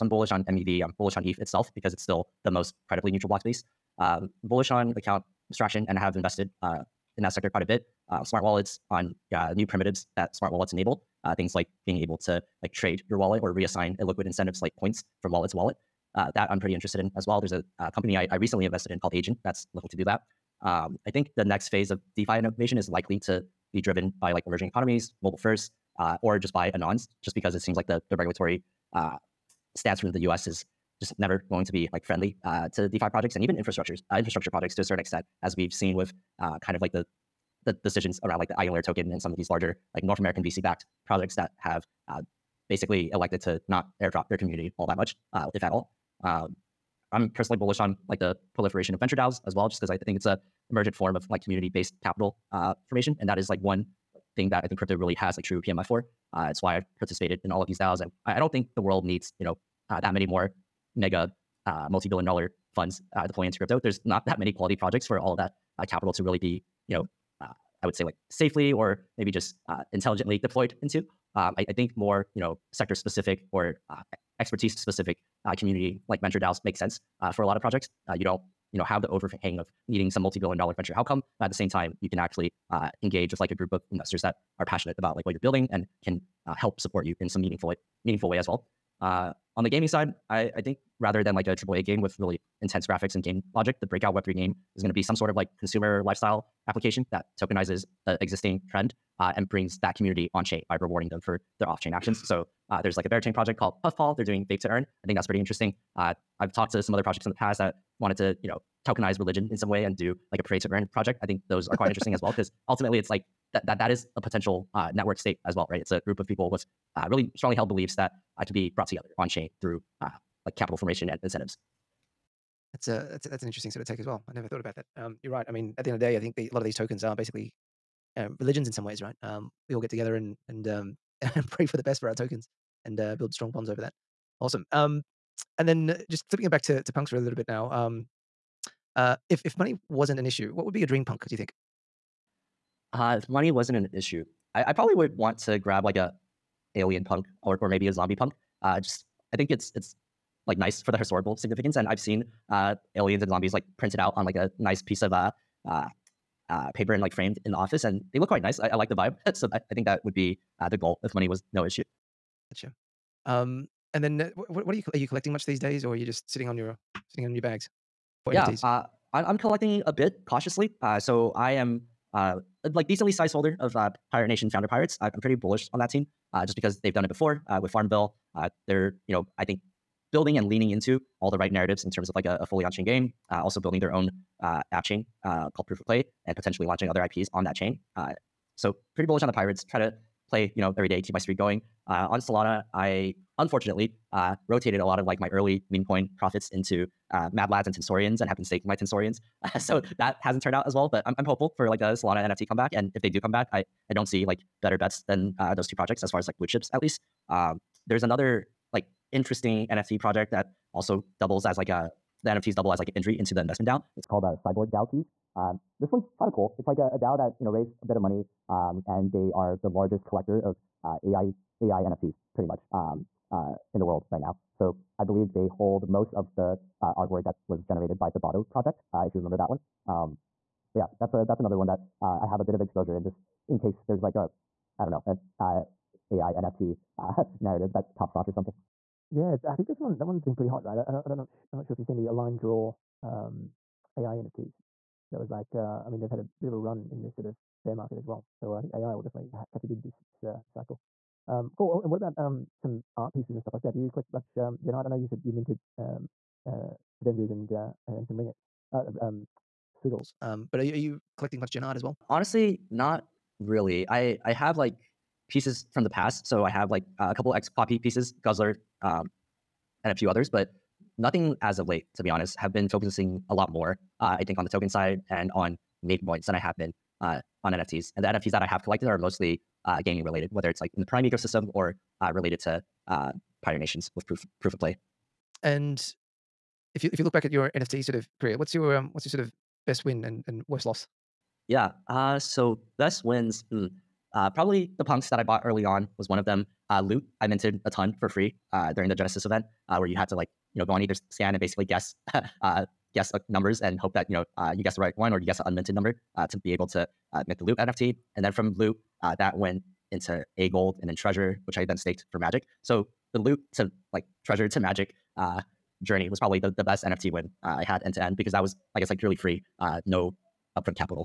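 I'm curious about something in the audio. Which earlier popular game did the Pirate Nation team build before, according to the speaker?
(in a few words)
Farmville.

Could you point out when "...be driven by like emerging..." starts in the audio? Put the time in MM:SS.
00:23.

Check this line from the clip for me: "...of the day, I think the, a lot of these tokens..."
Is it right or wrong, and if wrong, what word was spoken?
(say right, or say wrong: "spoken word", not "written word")
right.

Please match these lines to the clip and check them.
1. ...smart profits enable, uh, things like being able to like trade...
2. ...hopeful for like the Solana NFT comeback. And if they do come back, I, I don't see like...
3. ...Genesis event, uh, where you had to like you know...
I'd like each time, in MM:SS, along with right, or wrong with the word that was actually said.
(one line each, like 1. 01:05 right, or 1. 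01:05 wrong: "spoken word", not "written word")
1. 00:10 wrong: "wallets", not "profits"
2. 03:21 right
3. 04:58 right.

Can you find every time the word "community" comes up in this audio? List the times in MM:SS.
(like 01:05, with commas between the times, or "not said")
00:44, 00:51, 01:15, 01:39.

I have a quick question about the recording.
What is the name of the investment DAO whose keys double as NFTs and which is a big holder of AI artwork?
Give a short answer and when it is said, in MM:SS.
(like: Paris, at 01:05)
Cyborg DAO, at 03:34.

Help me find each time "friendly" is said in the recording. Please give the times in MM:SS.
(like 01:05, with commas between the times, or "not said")
00:32.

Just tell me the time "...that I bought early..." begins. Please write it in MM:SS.
04:55.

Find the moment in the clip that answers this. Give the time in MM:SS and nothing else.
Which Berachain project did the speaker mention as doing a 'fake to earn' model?
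01:43.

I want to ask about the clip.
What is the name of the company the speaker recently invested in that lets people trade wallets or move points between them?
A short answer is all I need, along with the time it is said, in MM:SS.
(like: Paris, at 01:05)
Agent, at 00:19.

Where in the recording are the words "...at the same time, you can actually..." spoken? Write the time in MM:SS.
01:21.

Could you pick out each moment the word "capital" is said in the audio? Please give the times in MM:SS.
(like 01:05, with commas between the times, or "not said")
00:52, 01:05, 02:00.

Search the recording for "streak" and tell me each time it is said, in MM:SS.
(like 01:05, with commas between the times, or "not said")
03:11.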